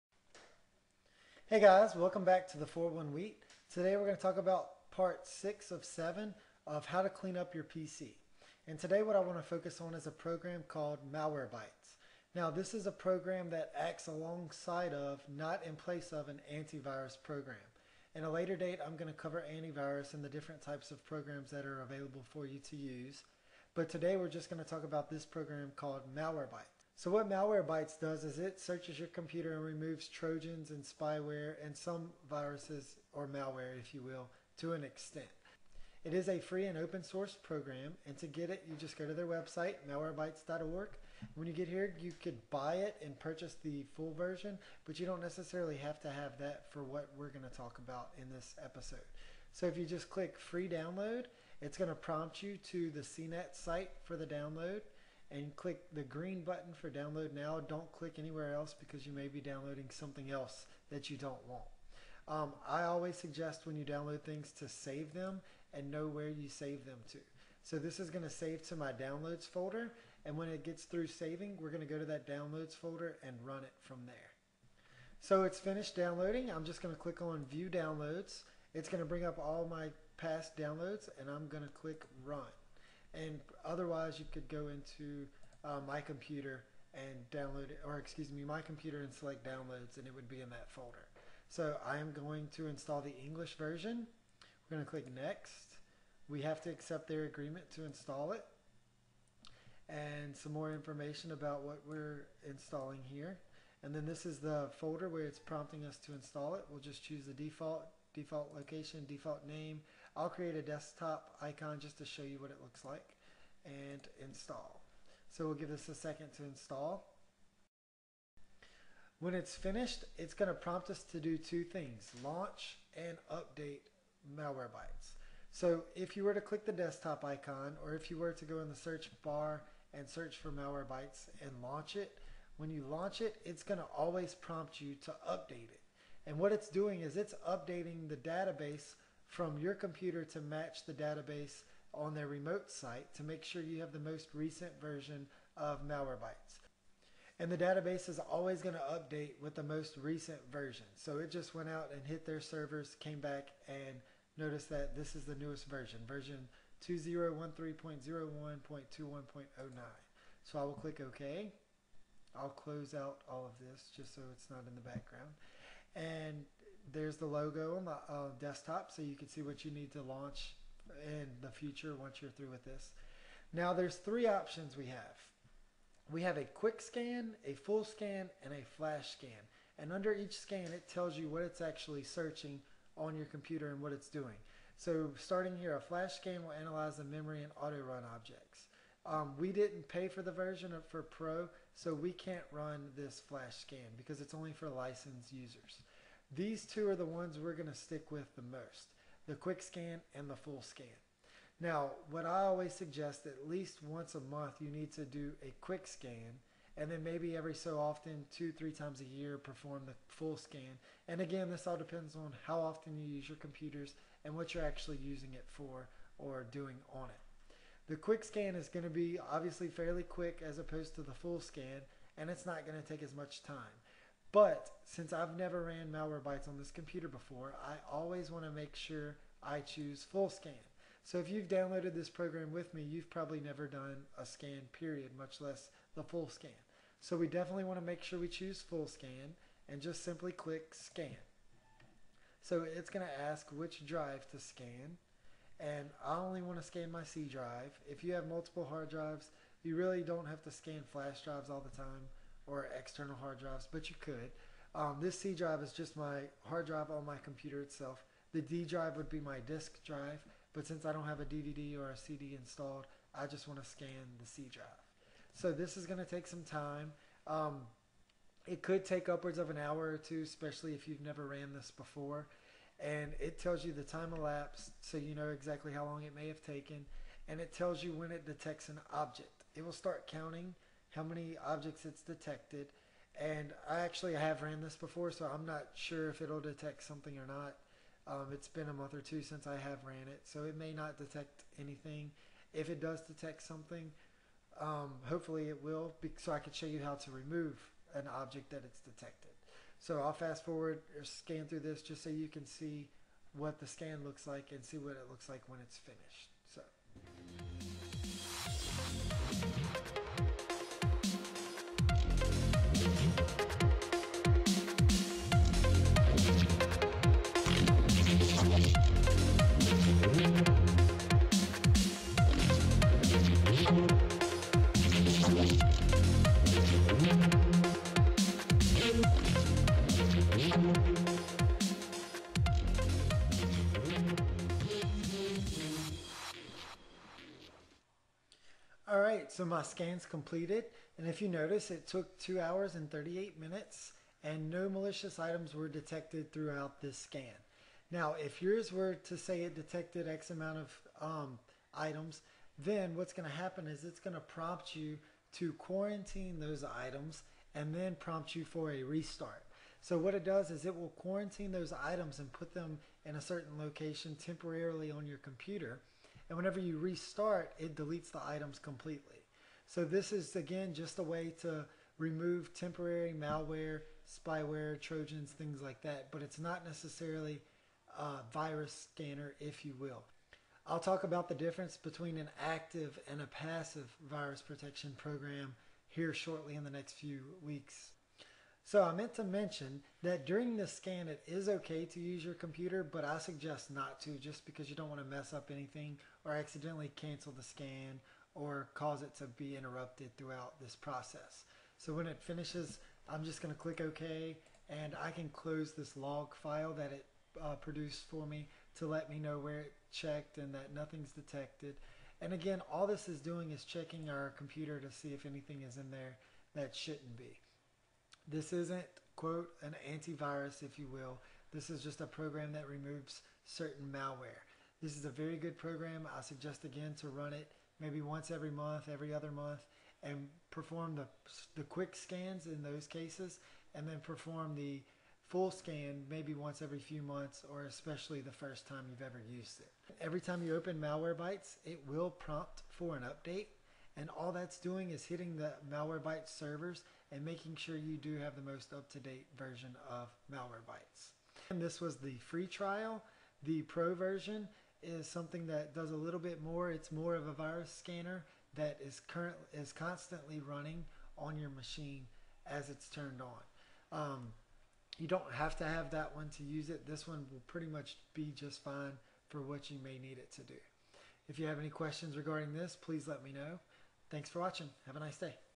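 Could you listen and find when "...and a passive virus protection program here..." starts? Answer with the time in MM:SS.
06:23.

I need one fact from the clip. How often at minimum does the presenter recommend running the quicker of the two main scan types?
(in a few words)
once a month.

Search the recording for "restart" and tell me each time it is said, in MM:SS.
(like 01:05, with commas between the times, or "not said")
05:58, 06:06.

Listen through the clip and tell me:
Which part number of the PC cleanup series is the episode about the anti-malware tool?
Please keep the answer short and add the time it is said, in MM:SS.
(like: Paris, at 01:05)
6, at 00:04.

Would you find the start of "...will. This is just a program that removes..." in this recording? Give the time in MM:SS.
07:00.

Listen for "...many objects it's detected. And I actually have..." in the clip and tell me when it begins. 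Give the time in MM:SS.
04:41.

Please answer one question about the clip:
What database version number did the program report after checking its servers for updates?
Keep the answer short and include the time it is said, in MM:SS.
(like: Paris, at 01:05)
2013.01.21.09, at 02:36.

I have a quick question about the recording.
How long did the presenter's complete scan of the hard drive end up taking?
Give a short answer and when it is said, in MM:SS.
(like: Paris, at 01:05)
2 hours 38 minutes, at 05:42.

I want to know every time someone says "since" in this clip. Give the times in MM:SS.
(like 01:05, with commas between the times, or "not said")
03:44, 04:20, 04:49.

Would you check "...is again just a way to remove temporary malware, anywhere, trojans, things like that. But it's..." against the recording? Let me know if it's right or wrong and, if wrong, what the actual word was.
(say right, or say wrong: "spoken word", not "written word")
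wrong: "spyware", not "anywhere".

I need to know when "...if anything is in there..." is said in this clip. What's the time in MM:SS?
06:55.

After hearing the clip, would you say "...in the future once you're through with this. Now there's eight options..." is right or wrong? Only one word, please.
wrong.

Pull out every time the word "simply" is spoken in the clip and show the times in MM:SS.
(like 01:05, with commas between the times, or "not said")
04:00.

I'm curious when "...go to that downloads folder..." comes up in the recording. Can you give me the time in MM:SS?
01:11.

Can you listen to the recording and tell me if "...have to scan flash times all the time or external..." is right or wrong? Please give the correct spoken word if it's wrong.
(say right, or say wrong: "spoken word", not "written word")
wrong: "drives", not "times".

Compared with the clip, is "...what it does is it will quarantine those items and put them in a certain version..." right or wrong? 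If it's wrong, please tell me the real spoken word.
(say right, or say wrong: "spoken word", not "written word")
wrong: "location", not "version".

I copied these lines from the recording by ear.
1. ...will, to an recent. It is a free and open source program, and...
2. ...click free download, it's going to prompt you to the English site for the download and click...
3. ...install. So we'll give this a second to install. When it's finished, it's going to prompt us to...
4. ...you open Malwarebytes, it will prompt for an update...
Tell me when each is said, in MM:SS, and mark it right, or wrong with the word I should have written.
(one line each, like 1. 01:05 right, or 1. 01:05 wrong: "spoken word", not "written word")
1. 00:34 wrong: "extent", not "recent"
2. 00:50 wrong: "CNET", not "English"
3. 01:54 right
4. 07:20 right.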